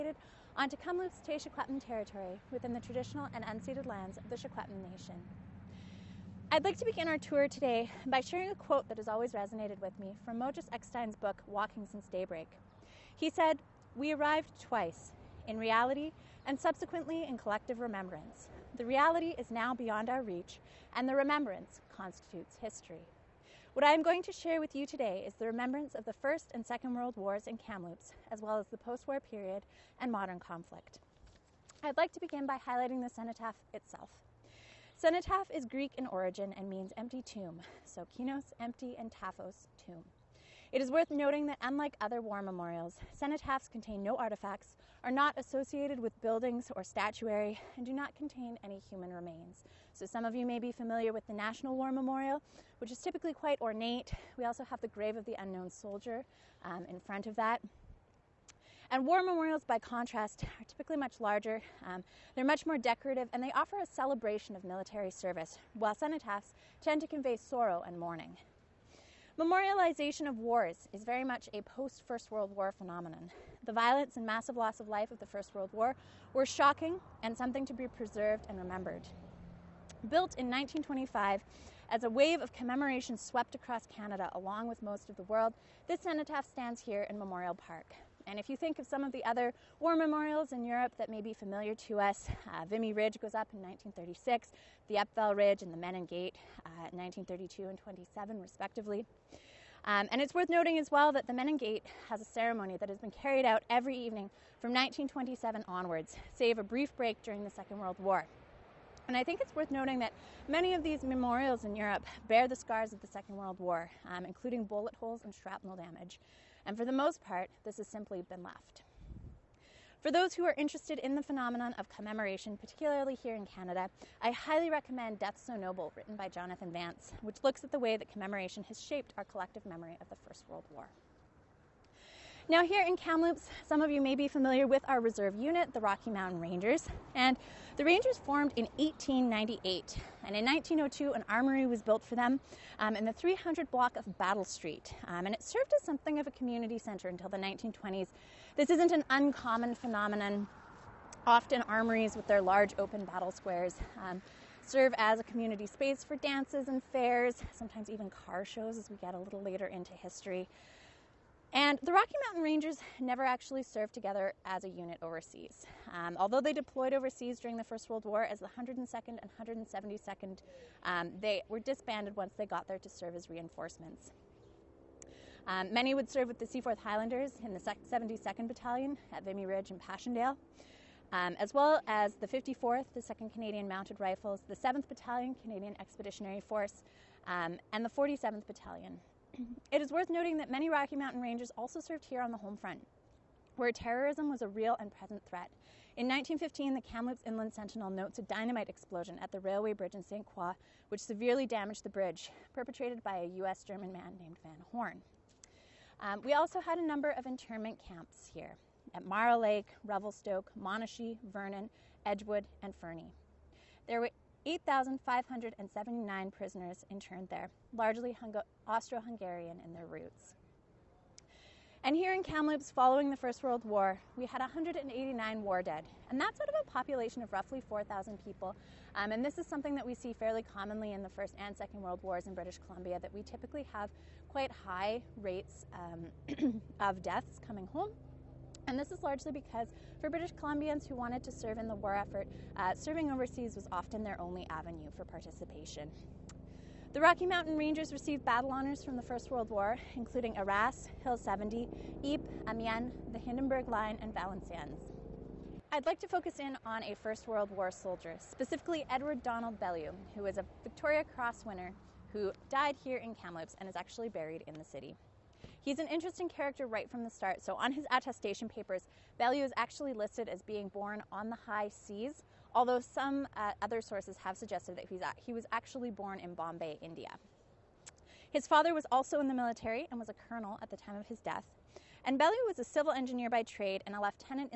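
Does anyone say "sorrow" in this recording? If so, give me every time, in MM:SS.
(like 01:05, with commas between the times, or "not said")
01:07.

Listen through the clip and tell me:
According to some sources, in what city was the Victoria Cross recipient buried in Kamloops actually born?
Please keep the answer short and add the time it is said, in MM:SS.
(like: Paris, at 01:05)
Bombay, India, at 04:36.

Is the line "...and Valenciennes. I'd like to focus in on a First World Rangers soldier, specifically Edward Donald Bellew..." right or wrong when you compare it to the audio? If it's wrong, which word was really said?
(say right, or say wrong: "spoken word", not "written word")
wrong: "War", not "Rangers".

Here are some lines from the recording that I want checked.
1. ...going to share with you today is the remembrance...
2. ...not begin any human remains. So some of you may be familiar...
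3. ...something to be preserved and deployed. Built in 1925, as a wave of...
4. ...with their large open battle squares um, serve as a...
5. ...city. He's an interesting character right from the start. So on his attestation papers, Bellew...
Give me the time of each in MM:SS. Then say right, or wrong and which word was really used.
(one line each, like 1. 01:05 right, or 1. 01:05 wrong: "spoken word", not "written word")
1. 00:24 right
2. 00:47 wrong: "contain", not "begin"
3. 01:17 wrong: "remembered", not "deployed"
4. 02:32 right
5. 04:24 right.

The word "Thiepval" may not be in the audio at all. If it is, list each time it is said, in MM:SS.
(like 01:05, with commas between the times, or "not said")
01:34.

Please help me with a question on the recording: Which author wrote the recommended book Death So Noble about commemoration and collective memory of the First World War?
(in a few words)
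Jonathan Vance.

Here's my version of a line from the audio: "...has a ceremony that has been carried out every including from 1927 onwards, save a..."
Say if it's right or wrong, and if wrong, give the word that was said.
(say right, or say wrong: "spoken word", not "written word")
wrong: "evening", not "including".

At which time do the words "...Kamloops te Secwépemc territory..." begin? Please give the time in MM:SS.
00:00.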